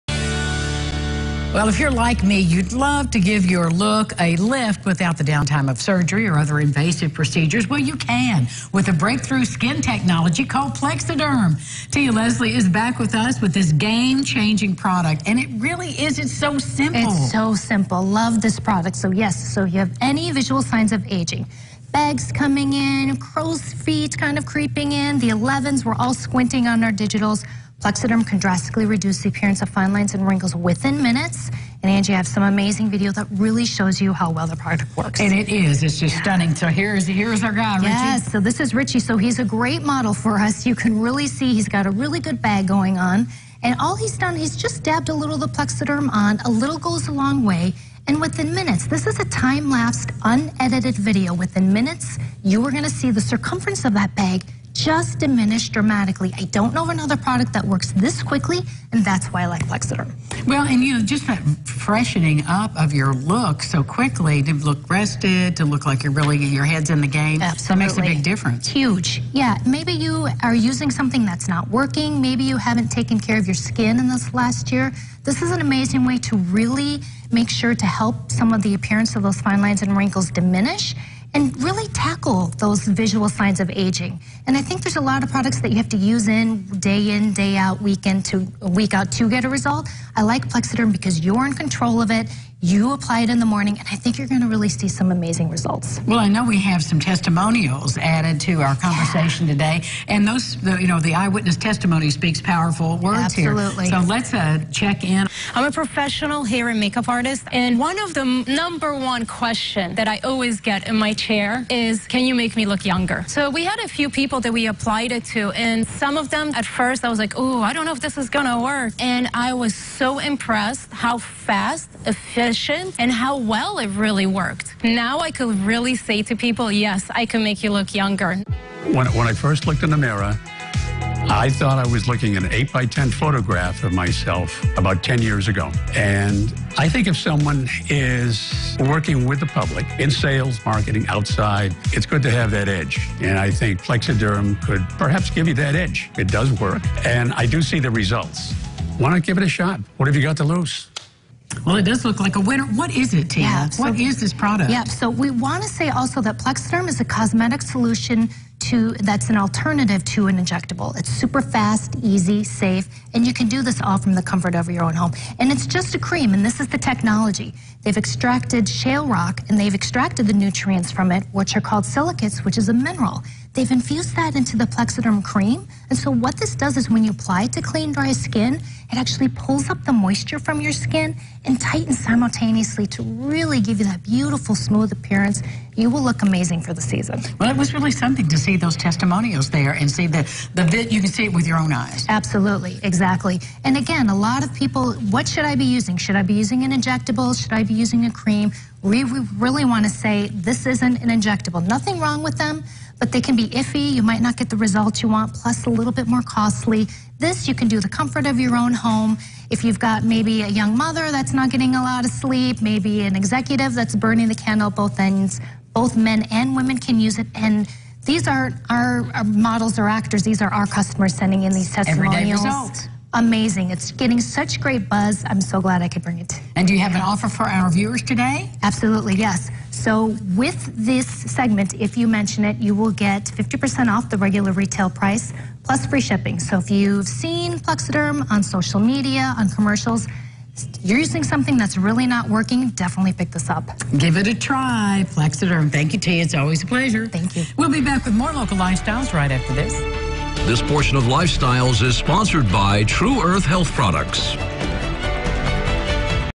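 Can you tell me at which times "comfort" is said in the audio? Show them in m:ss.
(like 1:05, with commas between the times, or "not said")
2:44, 3:27.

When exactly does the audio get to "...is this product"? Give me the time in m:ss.
2:33.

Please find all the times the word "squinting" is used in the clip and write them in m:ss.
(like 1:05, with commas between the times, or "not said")
0:26.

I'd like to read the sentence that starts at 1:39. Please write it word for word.
today, and those, the, you know, the eyewitness testimony speaks powerful words Absolutely.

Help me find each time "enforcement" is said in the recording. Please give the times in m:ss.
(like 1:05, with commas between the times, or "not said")
not said.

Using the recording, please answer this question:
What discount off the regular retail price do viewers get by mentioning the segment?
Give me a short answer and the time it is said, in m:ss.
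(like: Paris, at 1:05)
50%, at 3:53.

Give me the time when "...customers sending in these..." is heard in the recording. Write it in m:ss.
3:40.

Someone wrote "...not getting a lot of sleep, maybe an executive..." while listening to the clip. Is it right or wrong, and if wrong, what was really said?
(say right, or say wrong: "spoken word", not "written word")
right.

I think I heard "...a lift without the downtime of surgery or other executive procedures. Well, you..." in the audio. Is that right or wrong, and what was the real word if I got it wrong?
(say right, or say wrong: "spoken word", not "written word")
wrong: "invasive", not "executive".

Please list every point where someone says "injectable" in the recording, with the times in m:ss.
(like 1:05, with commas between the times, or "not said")
2:40, 3:16, 3:21.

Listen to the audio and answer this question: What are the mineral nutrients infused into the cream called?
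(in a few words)
silicates.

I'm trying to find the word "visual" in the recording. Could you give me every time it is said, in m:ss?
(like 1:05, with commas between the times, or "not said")
0:20, 1:22.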